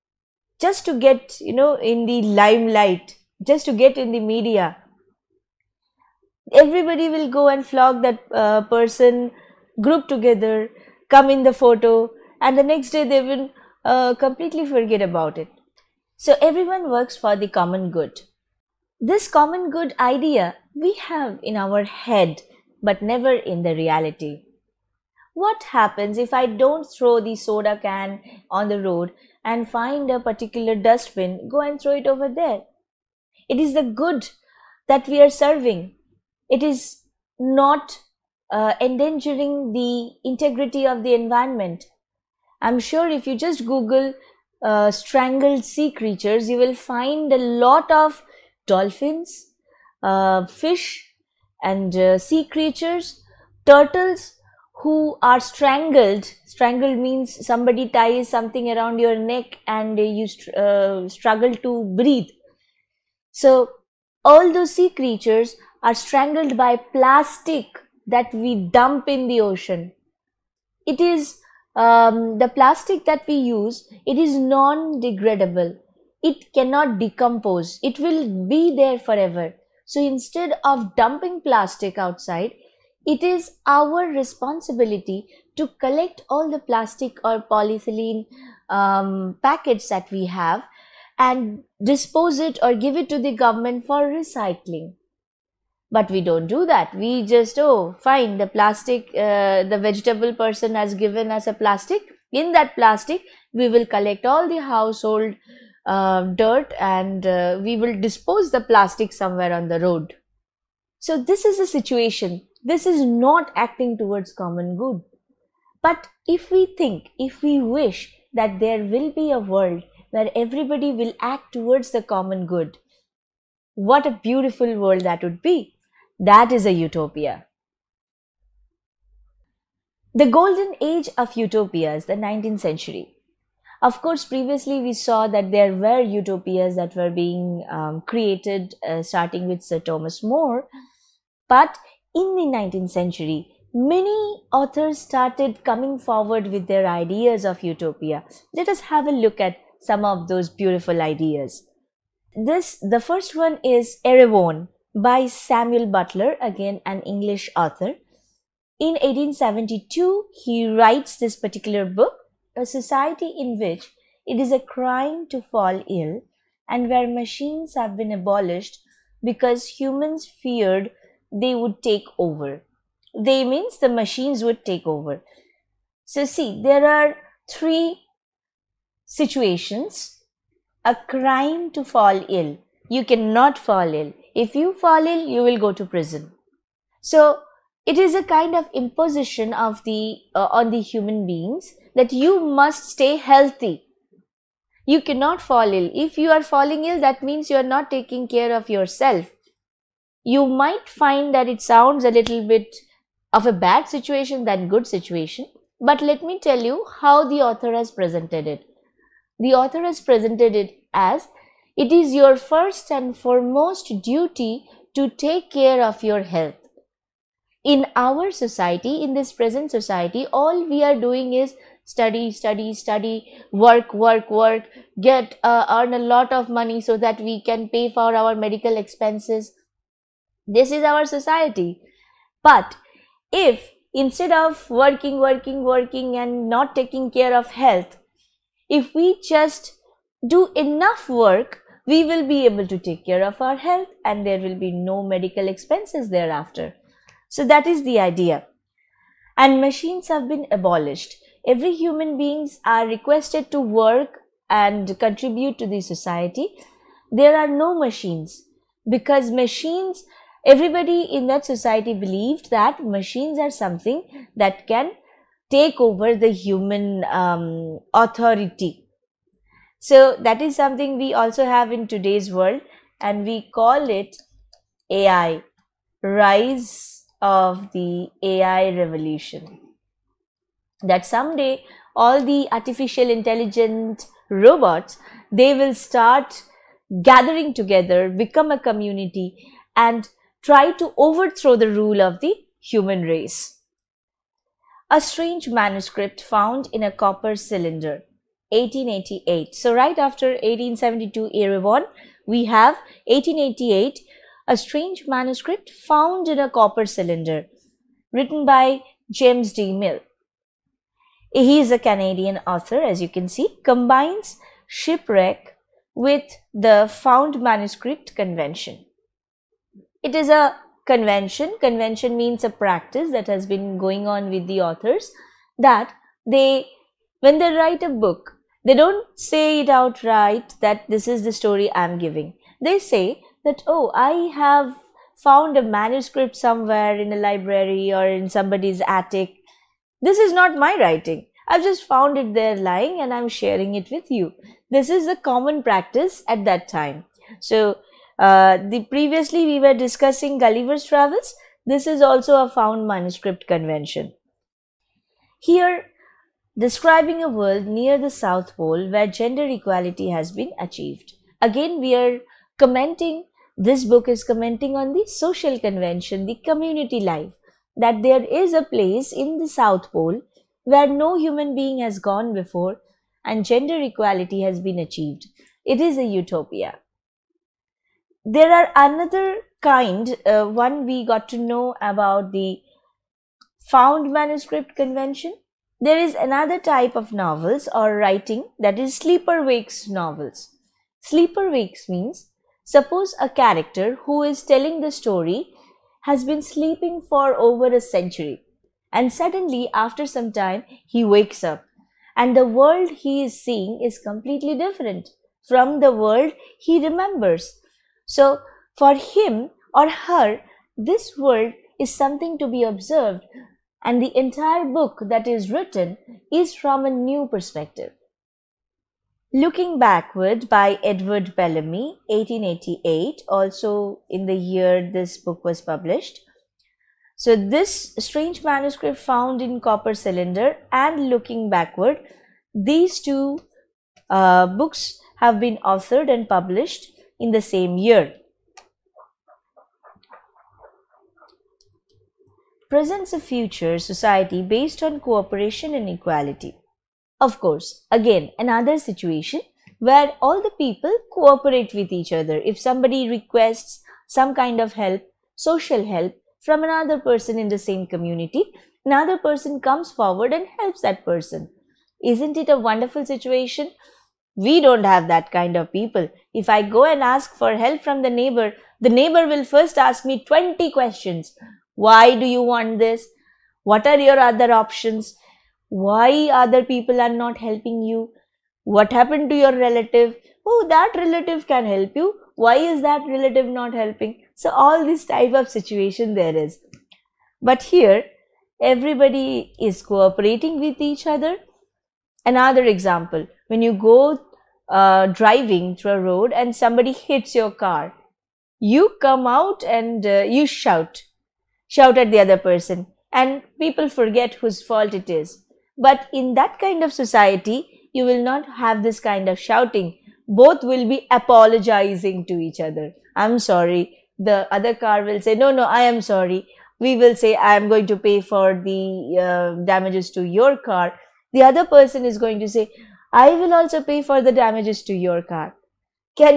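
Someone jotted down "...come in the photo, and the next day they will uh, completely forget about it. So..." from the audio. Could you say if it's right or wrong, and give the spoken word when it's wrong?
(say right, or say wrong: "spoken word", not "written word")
right.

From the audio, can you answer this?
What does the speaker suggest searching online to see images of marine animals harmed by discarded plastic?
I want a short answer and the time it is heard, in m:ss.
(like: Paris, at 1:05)
strangled sea creatures, at 0:44.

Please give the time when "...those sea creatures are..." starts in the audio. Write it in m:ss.
1:04.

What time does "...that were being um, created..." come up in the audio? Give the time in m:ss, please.
2:16.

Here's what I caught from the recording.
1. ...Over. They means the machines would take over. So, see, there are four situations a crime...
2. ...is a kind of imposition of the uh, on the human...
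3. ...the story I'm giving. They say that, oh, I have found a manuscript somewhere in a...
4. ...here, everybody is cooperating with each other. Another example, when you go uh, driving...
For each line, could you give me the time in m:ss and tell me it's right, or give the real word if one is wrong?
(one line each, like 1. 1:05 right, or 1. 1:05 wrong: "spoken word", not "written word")
1. 2:52 wrong: "three", not "four"
2. 3:07 right
3. 5:31 right
4. 8:07 right.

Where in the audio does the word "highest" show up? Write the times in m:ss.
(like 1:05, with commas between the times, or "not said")
not said.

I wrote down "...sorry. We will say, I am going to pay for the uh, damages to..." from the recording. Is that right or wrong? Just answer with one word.
right.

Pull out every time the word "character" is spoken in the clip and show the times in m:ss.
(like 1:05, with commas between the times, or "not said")
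6:33.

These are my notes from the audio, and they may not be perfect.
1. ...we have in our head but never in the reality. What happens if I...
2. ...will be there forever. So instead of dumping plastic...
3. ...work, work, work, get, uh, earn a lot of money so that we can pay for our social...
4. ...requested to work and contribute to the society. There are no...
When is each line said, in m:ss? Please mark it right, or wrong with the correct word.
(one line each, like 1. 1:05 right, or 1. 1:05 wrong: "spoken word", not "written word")
1. 0:20 right
2. 1:17 right
3. 3:43 wrong: "medical", not "social"
4. 4:12 right.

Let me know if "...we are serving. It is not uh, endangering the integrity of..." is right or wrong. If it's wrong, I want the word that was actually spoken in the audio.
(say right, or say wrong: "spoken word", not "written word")
right.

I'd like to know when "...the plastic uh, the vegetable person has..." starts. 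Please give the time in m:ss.
1:38.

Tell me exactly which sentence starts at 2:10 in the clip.
The golden age of utopia is the 19th century.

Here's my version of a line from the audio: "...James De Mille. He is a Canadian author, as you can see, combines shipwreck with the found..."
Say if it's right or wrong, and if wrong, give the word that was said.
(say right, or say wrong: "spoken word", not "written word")
right.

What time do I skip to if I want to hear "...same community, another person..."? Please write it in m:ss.
7:37.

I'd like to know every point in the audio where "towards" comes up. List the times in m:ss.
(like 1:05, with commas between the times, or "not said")
1:53, 2:01.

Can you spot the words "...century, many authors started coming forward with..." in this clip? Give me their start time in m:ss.
2:22.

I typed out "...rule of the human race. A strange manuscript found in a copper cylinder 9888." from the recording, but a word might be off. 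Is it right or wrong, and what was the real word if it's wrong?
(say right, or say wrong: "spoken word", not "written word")
wrong: "1888", not "9888".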